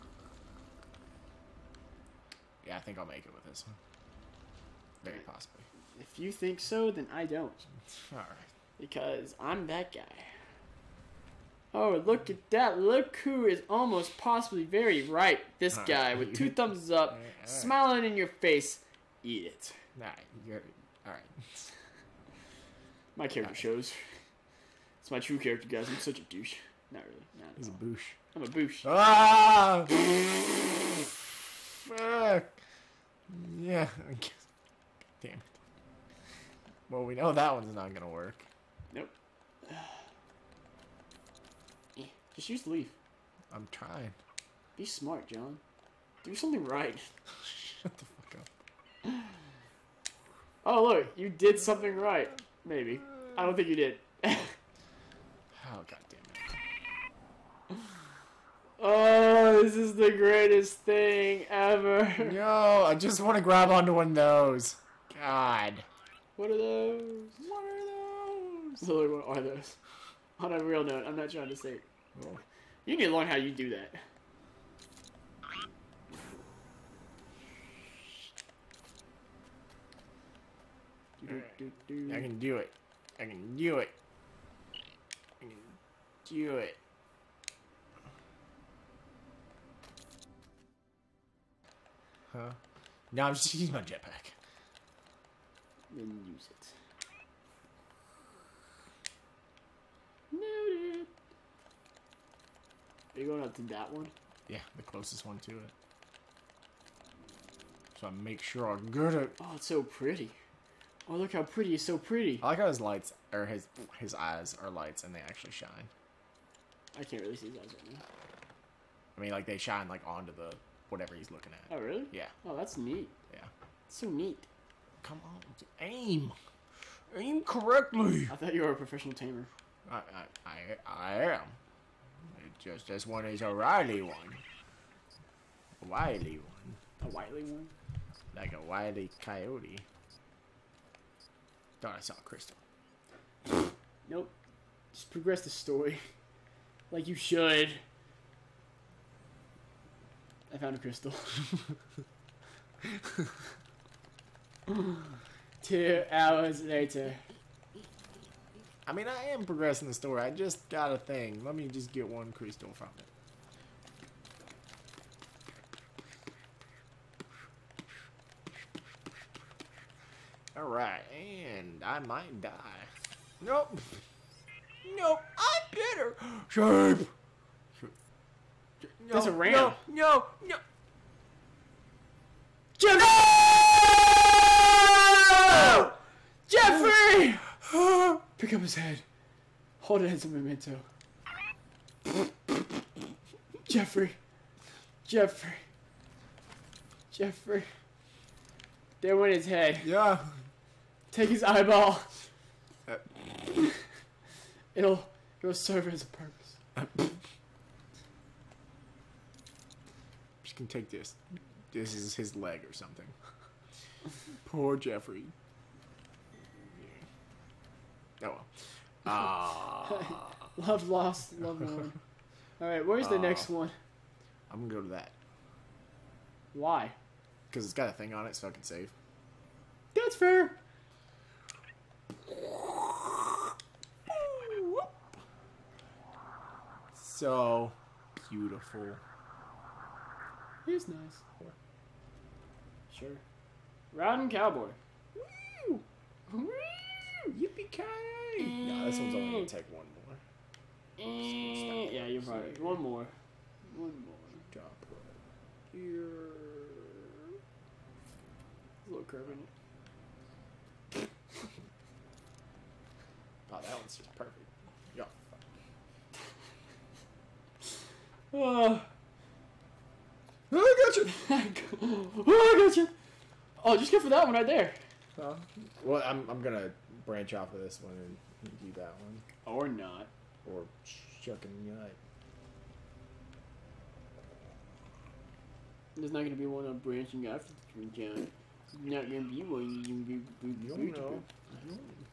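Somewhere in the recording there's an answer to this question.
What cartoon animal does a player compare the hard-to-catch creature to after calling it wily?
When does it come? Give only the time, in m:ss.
2:18.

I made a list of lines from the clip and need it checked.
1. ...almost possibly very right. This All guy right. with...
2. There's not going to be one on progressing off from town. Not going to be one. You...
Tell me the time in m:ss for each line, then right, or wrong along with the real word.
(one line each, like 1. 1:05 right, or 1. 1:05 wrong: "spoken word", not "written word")
1. 0:13 right
2. 4:45 wrong: "branching", not "progressing".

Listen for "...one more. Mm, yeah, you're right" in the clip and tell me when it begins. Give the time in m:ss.
4:09.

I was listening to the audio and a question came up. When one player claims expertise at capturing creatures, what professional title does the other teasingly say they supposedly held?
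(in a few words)
professional tamer.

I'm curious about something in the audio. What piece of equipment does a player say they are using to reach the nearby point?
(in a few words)
jetpack.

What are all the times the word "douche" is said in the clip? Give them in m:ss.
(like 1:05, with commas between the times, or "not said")
0:26.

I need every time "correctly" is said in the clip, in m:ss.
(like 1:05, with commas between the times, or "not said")
2:07.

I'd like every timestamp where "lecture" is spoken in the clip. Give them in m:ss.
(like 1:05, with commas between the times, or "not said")
not said.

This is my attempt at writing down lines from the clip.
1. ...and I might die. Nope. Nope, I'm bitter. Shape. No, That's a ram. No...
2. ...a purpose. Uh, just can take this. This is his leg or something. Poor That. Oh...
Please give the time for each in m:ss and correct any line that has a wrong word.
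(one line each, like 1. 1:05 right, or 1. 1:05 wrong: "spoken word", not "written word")
1. 2:51 right
2. 3:26 wrong: "Jeffrey", not "That".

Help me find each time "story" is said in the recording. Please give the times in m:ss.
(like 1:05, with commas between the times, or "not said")
2:25, 2:39.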